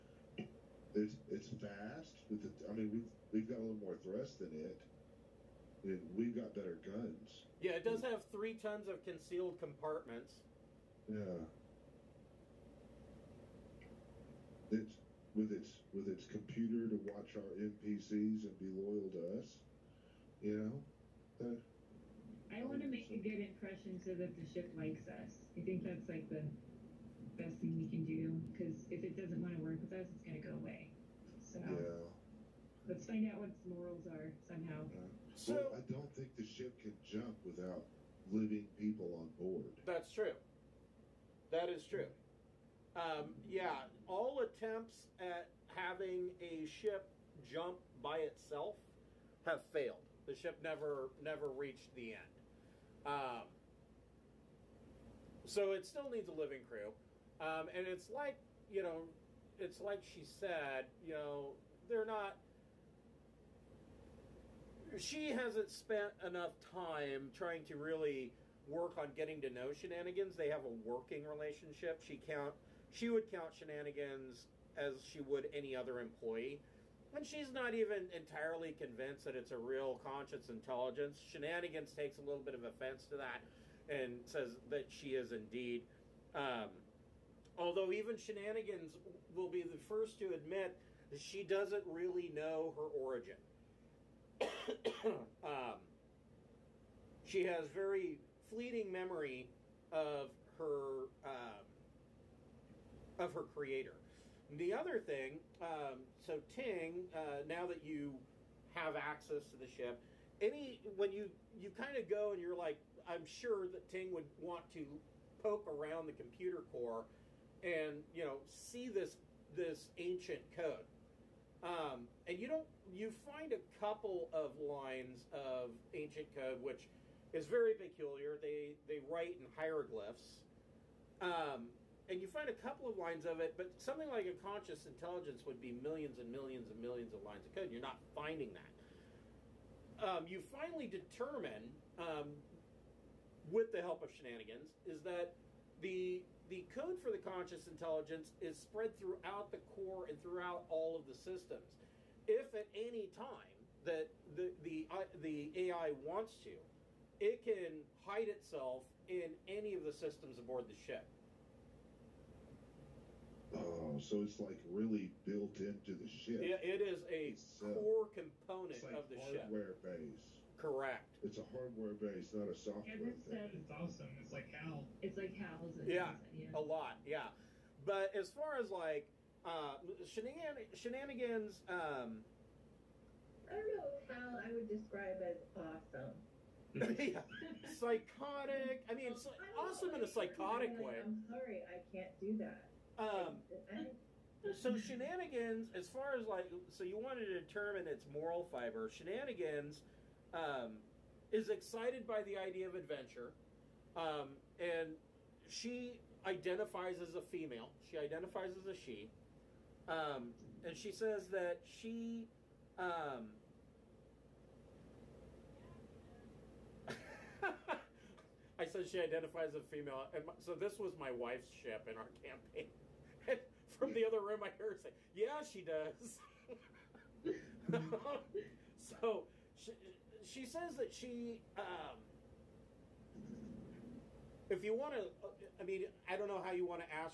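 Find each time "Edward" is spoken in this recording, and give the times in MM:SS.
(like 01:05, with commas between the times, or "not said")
02:52.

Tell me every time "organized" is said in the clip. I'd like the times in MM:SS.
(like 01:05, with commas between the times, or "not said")
not said.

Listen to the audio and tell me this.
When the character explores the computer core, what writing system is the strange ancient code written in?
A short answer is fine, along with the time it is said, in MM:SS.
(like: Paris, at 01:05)
Hieroglyphs, at 02:09.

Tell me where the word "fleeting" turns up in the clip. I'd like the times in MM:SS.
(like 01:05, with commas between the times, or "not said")
01:38.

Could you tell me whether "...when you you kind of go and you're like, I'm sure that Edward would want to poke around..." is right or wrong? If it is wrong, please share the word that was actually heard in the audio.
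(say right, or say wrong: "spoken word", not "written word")
wrong: "Ting", not "Edward".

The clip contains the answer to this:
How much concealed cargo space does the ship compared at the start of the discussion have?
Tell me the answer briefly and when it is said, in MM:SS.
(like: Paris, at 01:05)
3 tons, at 00:08.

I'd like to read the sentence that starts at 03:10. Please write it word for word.
Like, I'm sorry, I can't do that.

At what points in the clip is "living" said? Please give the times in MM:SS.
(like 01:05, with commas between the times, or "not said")
00:38, 00:56.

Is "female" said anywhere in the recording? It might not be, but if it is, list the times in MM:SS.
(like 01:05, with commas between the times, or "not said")
03:27, 03:39.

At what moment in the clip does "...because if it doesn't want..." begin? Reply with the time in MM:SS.
00:28.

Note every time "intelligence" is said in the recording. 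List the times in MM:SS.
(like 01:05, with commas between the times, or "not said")
01:20, 02:14, 02:27.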